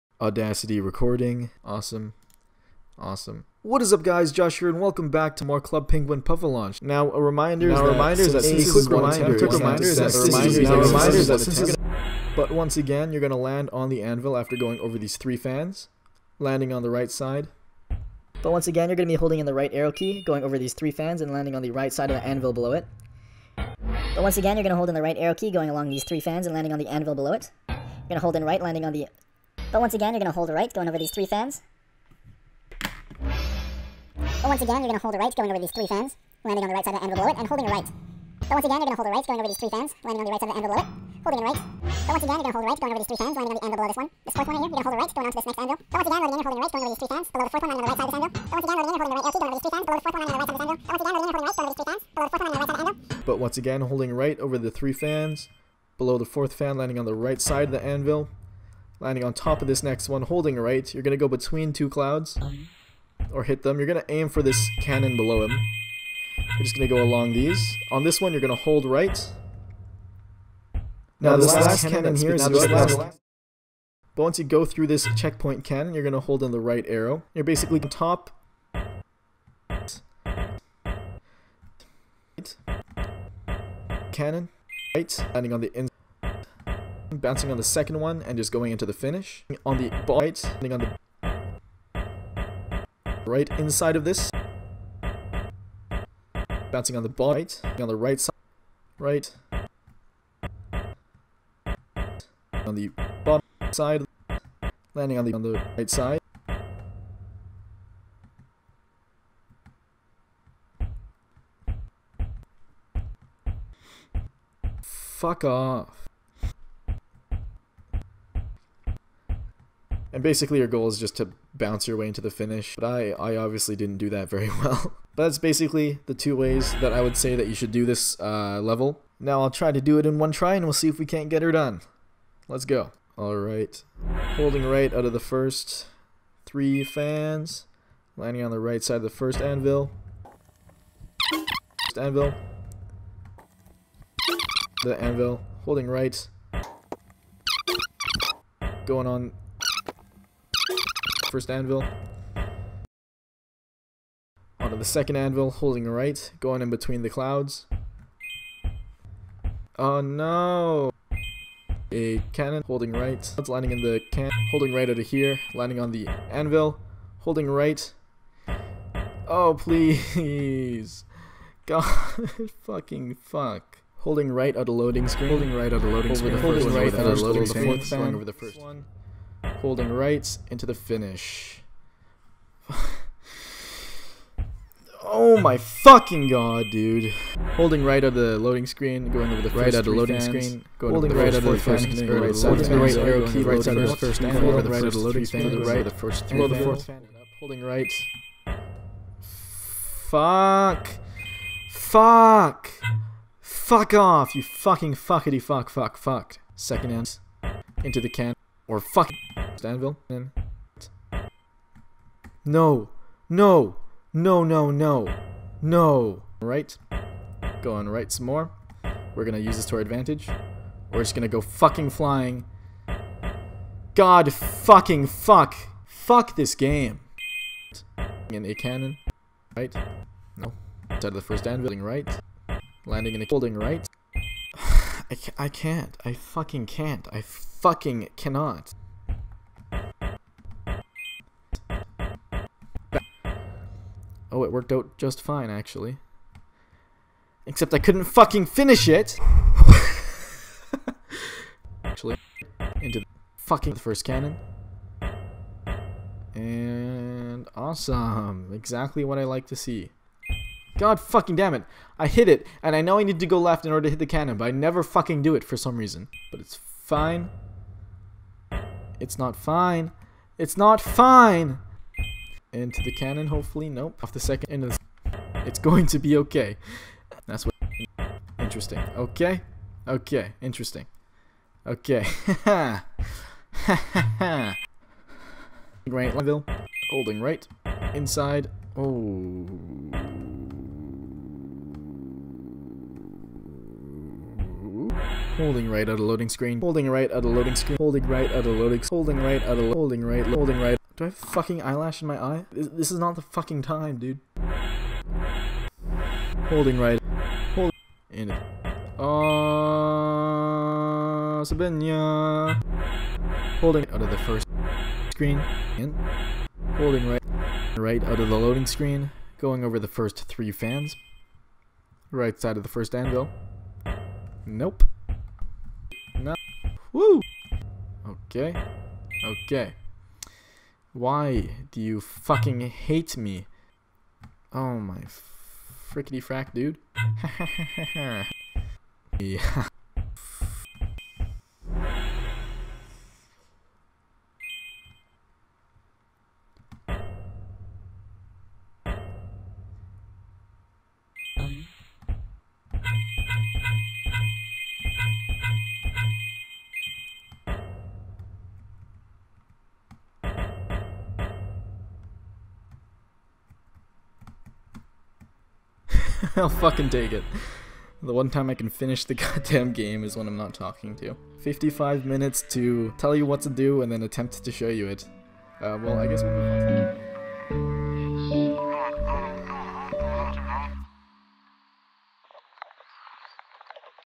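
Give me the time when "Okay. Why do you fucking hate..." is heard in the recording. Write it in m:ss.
5:29.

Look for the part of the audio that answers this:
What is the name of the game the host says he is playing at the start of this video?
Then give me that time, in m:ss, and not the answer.
0:05.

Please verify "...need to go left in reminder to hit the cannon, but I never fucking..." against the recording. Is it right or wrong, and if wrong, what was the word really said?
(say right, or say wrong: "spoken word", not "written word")
wrong: "order", not "reminder".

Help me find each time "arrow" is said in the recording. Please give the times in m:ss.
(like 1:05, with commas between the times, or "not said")
0:19, 0:25, 1:16, 3:12.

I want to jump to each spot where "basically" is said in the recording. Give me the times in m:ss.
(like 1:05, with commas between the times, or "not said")
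1:17, 2:00, 2:05.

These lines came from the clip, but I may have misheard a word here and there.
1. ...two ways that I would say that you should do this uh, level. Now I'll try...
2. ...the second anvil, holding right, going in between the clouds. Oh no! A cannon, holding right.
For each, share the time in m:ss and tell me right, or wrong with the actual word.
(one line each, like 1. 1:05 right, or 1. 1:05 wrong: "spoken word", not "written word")
1. 2:06 right
2. 2:34 right.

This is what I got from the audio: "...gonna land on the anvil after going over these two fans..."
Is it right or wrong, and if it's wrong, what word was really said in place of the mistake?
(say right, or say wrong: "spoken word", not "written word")
wrong: "three", not "two".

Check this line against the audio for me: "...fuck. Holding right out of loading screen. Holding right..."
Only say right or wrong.
right.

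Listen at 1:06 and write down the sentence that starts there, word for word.
You're just going to go along these.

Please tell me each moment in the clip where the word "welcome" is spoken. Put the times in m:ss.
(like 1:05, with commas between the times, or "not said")
0:04.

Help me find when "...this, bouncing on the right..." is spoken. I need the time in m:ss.
1:34.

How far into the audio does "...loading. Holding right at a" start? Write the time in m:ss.
4:58.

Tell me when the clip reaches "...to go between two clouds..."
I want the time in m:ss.
1:01.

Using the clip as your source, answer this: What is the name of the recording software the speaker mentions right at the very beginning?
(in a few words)
Audacity.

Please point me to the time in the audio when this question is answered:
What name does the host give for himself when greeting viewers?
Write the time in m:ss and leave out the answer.
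0:04.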